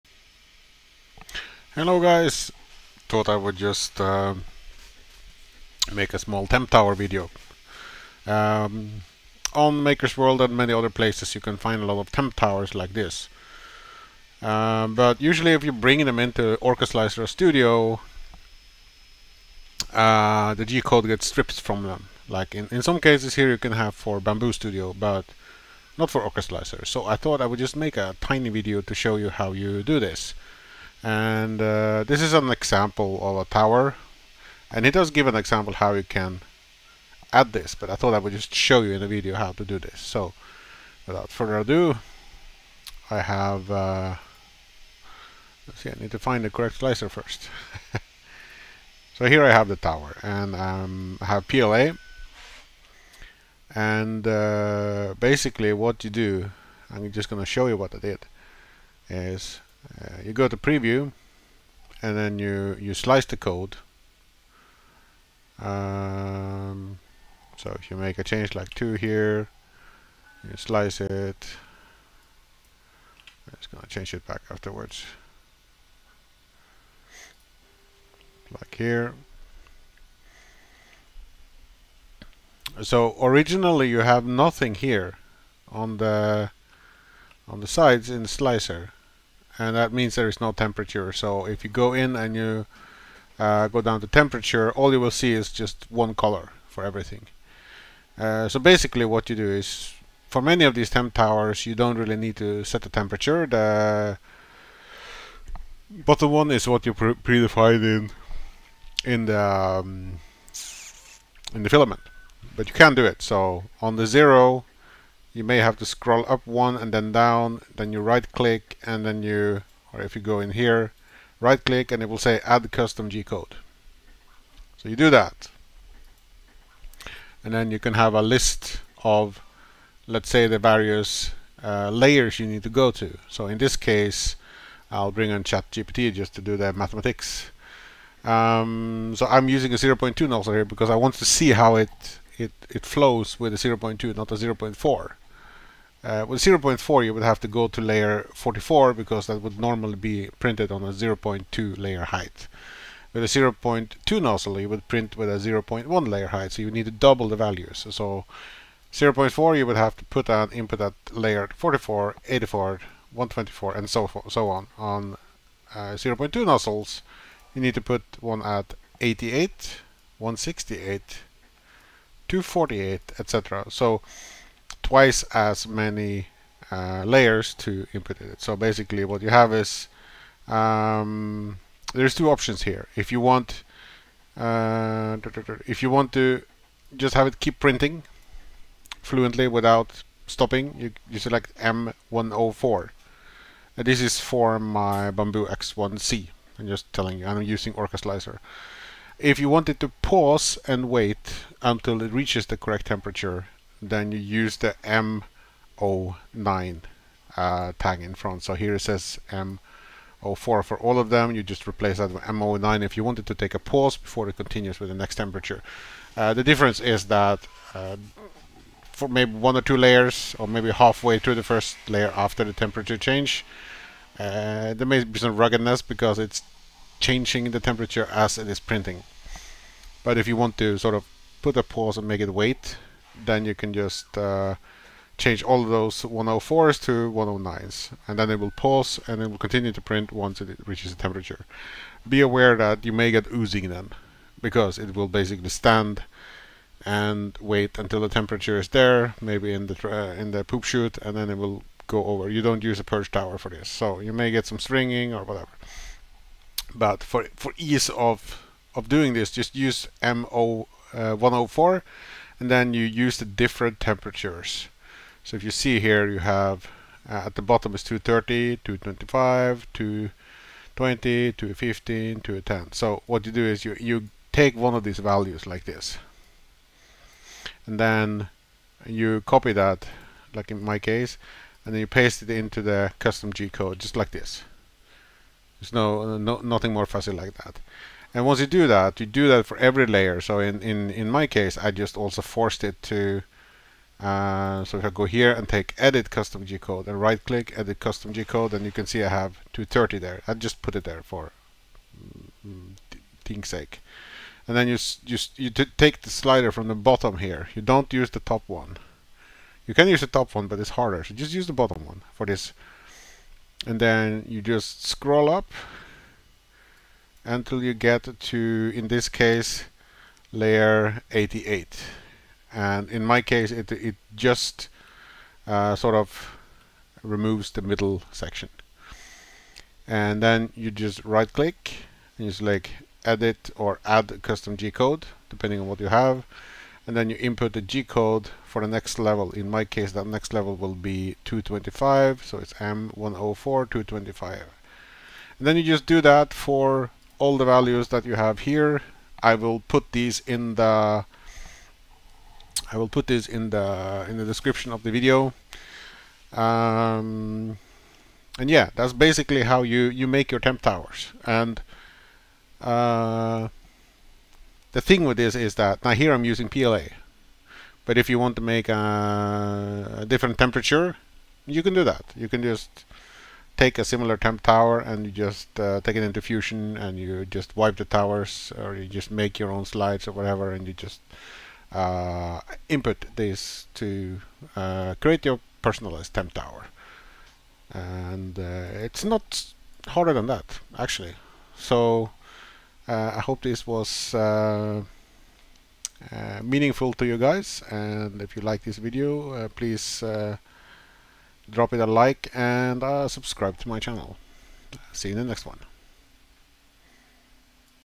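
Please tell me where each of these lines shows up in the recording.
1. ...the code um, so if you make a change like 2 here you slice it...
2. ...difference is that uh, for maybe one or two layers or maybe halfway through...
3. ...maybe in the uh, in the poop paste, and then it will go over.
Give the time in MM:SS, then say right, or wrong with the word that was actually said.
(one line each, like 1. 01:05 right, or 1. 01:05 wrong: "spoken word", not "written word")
1. 01:03 right
2. 03:36 right
3. 04:09 wrong: "chute", not "paste".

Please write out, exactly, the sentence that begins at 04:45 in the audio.
There's no, no nothing more fuzzy like that.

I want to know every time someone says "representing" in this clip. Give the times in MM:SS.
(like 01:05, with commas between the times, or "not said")
not said.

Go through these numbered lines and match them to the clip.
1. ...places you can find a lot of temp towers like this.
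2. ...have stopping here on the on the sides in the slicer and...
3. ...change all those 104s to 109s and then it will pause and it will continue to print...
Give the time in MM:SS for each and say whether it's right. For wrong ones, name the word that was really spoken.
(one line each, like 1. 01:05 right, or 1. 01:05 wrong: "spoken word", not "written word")
1. 00:10 right
2. 01:23 wrong: "nothing", not "stopping"
3. 03:55 right.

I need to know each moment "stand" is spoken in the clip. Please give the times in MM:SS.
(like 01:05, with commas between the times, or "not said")
04:05.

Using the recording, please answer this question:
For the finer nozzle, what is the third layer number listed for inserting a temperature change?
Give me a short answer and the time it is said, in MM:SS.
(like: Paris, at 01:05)
248, at 02:52.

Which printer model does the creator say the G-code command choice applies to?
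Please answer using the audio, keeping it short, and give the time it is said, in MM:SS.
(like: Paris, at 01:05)
Bambu X1C, at 03:15.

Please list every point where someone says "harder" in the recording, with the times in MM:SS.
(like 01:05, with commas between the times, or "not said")
05:10, 06:29.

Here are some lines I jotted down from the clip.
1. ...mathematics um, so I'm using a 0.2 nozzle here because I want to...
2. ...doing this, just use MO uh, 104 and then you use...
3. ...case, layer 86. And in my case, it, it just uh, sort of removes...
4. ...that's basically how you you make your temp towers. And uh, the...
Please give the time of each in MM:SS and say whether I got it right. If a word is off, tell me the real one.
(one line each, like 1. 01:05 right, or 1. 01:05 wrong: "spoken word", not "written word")
1. 02:16 right
2. 04:18 right
3. 05:19 wrong: "88", not "86"
4. 05:58 right.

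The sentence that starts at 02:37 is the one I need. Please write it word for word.
So 0.4 you would have to put an input at layer 44, 84, 124 and so, so on.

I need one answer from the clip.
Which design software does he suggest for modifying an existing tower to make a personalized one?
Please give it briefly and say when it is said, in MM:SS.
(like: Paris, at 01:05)
Fusion, at 06:16.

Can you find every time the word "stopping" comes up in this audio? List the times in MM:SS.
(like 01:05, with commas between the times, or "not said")
03:10.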